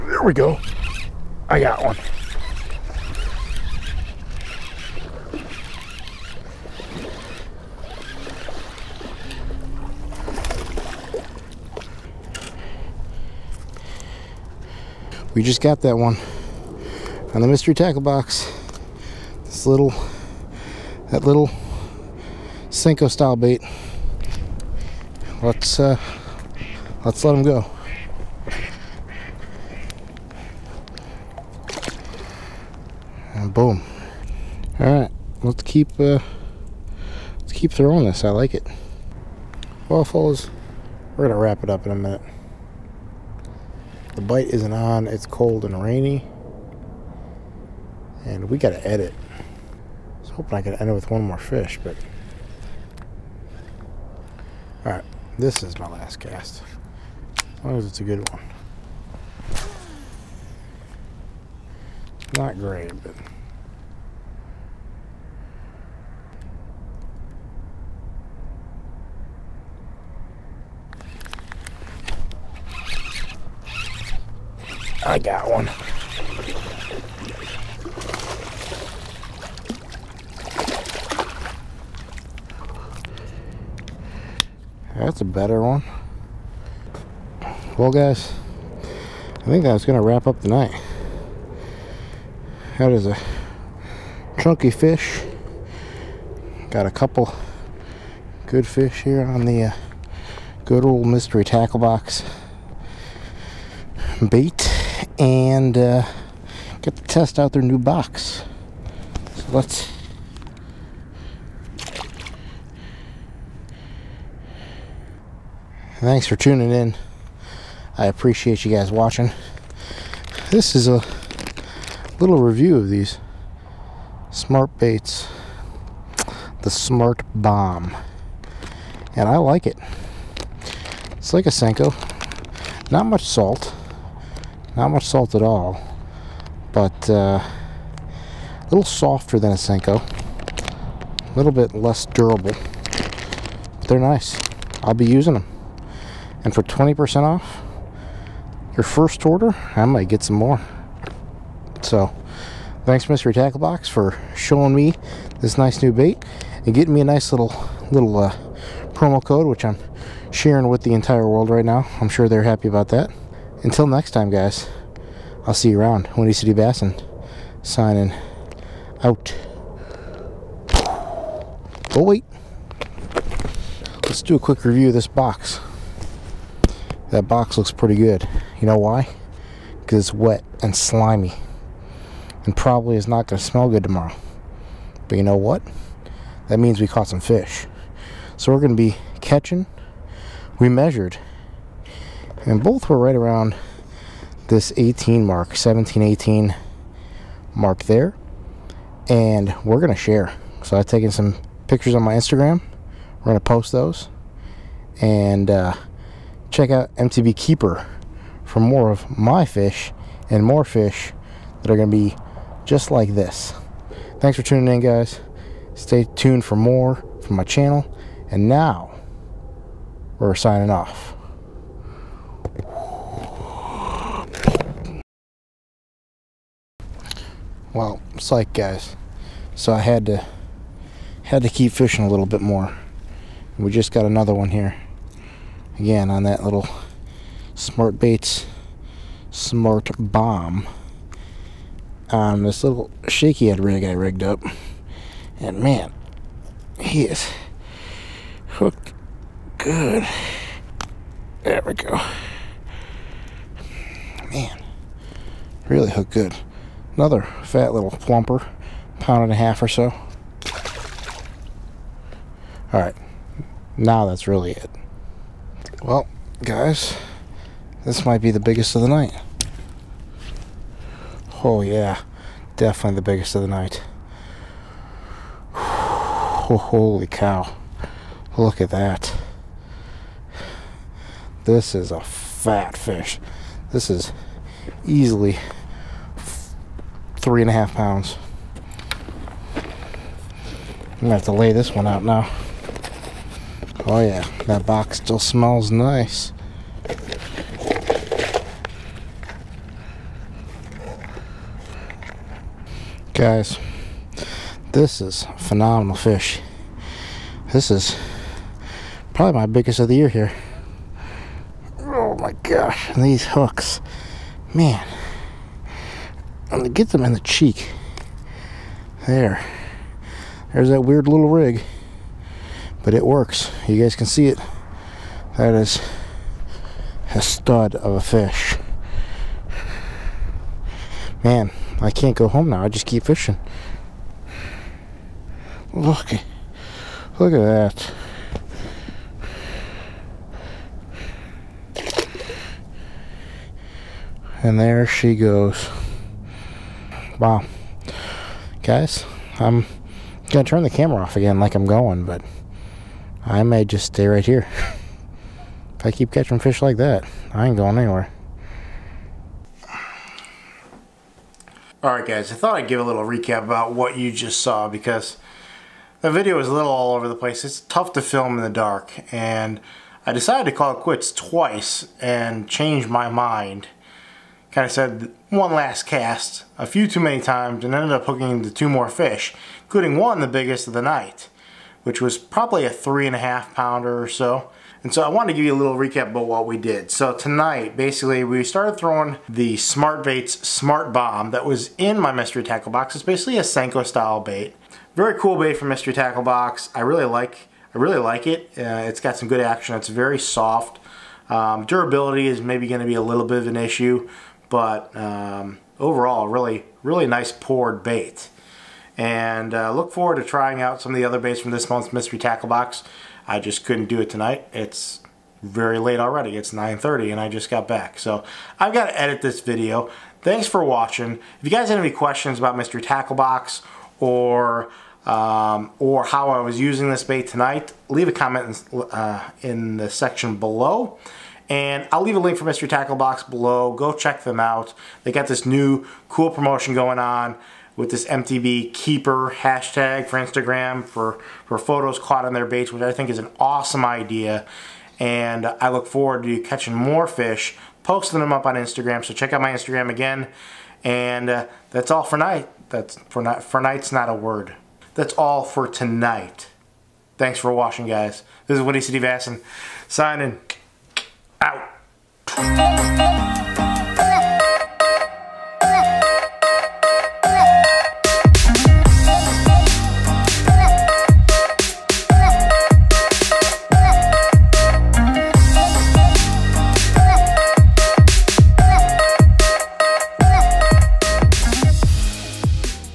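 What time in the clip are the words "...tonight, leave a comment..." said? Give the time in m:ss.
7:07.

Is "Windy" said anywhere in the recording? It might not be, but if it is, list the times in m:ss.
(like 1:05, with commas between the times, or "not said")
2:46, 7:38.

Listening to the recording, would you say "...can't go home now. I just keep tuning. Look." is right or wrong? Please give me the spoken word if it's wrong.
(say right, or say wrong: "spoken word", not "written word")
wrong: "fishing", not "tuning".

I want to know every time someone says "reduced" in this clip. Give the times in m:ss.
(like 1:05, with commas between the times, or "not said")
not said.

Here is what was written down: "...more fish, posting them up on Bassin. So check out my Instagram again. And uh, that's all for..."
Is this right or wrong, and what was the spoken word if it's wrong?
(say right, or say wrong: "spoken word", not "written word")
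wrong: "Instagram", not "Bassin".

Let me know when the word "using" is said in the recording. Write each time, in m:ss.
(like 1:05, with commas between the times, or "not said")
2:25, 7:06.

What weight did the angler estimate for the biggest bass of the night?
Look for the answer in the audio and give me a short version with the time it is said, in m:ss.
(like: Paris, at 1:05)
3.5 pounds, at 4:47.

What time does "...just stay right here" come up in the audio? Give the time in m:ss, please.
5:53.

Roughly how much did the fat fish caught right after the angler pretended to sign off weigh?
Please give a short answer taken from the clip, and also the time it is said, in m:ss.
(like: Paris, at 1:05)
pound and a half, at 4:19.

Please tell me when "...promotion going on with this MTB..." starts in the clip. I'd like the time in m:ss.
7:16.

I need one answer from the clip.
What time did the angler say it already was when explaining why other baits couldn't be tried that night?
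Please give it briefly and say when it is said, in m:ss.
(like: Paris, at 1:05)
9:30, at 6:56.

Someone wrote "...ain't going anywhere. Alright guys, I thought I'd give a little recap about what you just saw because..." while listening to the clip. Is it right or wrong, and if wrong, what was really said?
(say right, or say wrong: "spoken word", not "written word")
right.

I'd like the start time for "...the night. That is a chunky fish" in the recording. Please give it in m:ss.
1:30.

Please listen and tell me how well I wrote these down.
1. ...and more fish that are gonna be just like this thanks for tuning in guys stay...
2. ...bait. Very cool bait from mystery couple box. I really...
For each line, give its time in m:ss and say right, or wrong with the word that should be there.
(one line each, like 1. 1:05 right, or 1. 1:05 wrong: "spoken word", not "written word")
1. 3:30 right
2. 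6:34 wrong: "tackle", not "couple".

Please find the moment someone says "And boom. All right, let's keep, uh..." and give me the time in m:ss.
0:33.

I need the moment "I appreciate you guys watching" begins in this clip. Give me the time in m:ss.
1:57.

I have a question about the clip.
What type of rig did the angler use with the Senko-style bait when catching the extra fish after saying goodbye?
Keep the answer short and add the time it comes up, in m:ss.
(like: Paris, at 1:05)
shaky head rig, at 4:03.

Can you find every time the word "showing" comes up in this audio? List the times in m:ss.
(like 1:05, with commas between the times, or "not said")
2:34.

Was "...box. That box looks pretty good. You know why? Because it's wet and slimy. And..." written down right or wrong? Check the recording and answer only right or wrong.
right.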